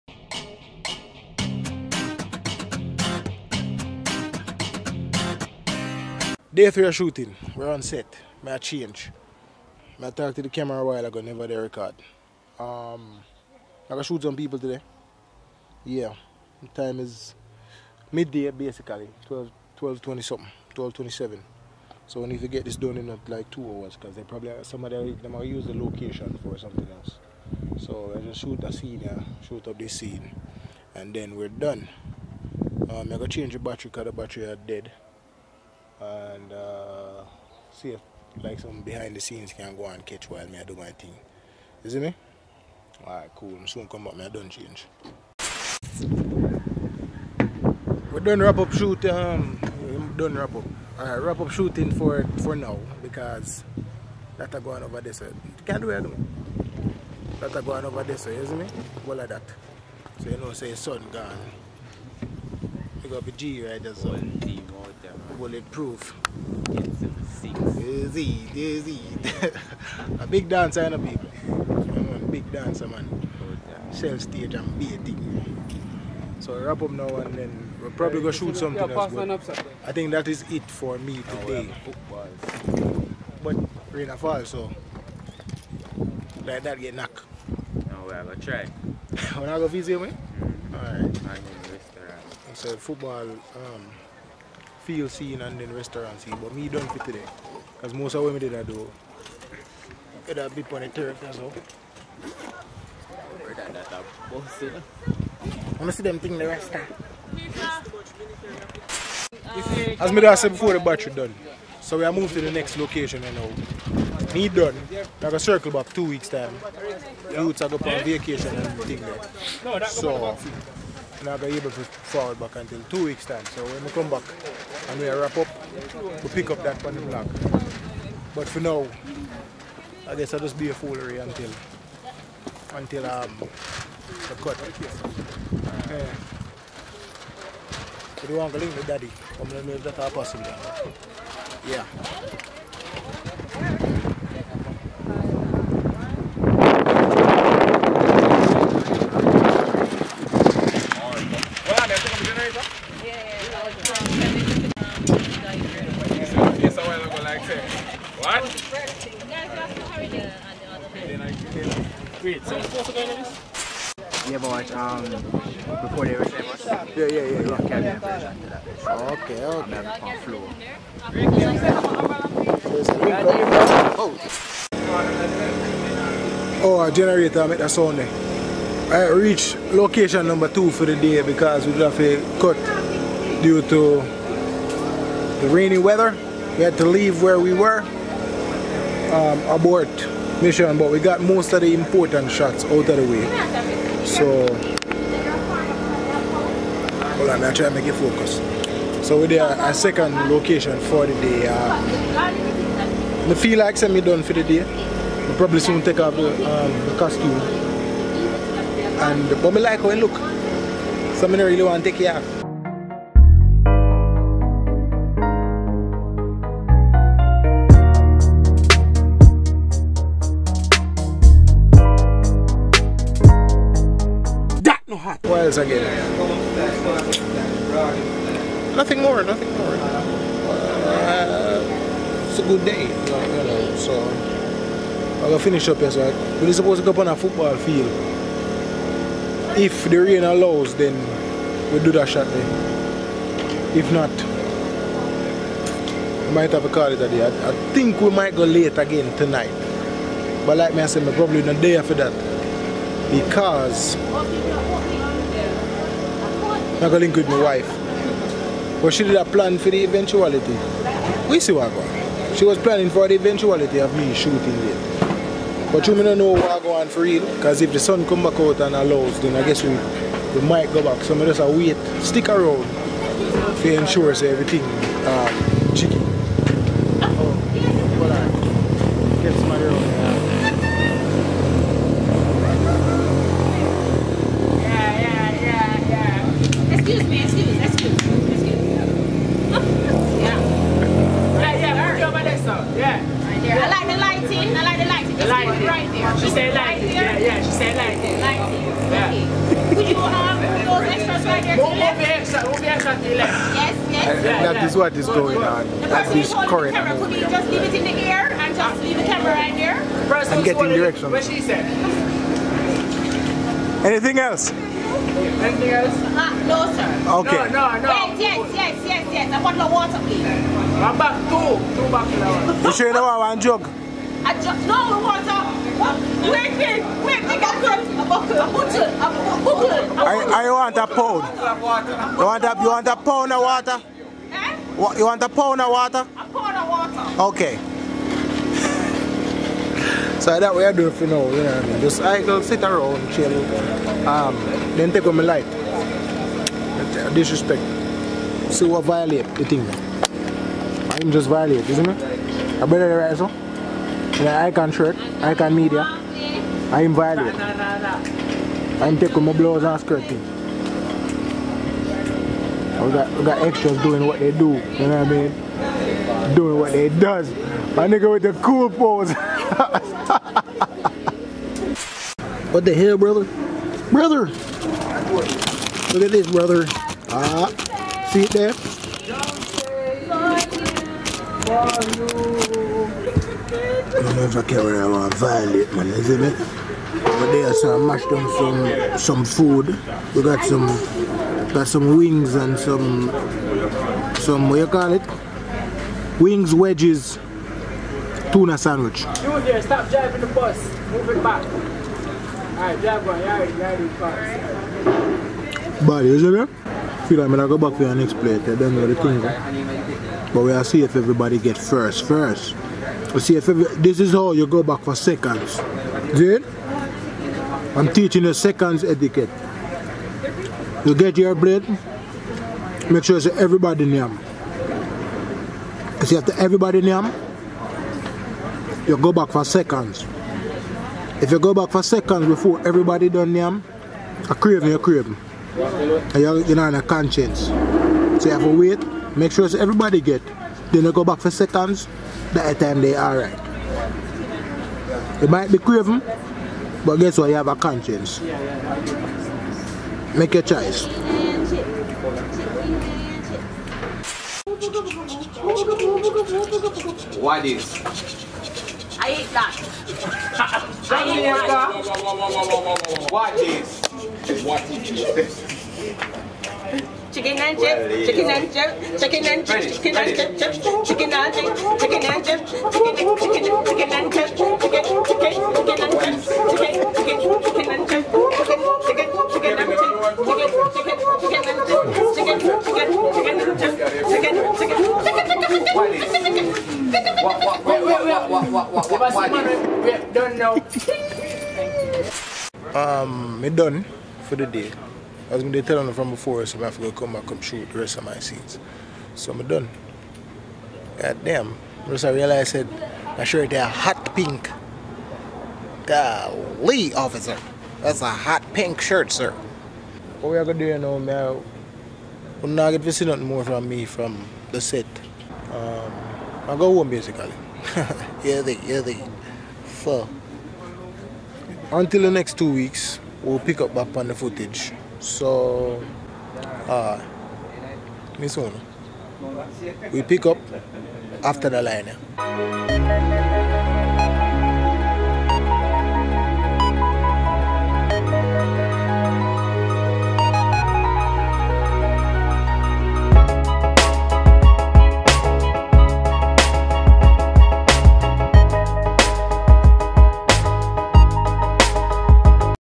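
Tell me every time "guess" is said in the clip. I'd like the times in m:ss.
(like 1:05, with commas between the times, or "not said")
2:10, 4:29, 7:26.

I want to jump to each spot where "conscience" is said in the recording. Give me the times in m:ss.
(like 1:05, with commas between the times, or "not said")
7:16, 7:27.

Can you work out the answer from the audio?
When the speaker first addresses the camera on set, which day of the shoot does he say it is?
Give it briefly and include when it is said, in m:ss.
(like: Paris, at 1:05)
Day three, at 0:06.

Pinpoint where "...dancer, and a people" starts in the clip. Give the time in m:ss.
1:10.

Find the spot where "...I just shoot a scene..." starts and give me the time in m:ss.
0:28.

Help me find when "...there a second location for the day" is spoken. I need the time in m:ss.
3:19.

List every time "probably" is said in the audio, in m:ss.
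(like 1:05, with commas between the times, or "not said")
0:24, 1:17, 3:25, 4:11.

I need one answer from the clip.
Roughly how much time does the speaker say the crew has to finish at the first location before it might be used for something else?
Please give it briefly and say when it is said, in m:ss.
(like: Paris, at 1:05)
2 hours, at 0:23.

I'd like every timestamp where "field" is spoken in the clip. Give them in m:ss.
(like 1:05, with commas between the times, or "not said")
1:34, 3:57.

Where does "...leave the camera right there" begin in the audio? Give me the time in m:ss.
5:08.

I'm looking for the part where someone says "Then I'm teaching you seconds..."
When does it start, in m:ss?
6:56.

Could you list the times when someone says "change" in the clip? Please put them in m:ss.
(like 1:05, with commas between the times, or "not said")
0:08, 0:33, 0:44.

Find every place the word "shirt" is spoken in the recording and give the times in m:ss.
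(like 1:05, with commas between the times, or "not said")
5:54, 8:23, 8:28.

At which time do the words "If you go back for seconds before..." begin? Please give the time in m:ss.
7:11.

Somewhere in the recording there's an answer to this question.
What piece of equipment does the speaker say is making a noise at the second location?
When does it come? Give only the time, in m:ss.
2:56.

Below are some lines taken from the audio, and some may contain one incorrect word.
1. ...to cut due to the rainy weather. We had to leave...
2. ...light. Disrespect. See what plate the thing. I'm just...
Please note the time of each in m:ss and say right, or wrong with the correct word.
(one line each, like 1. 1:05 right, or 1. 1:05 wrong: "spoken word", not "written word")
1. 3:01 right
2. 5:45 wrong: "violate", not "plate".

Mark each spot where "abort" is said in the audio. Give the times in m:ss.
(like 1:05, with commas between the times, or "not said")
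3:09.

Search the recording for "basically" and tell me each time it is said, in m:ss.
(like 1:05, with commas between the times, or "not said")
0:18, 8:36.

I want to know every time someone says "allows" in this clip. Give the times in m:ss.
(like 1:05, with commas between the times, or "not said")
4:00, 4:28.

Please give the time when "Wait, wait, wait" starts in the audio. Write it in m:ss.
5:26.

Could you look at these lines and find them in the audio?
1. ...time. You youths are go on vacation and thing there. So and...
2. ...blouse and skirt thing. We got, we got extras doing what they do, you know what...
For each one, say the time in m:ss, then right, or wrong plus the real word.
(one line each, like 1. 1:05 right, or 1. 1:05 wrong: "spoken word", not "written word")
1. 1:56 right
2. 5:59 right.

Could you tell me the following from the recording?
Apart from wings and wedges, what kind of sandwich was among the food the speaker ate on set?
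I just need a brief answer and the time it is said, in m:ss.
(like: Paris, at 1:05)
Tuna sandwich, at 6:38.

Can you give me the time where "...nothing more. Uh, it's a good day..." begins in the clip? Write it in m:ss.
3:49.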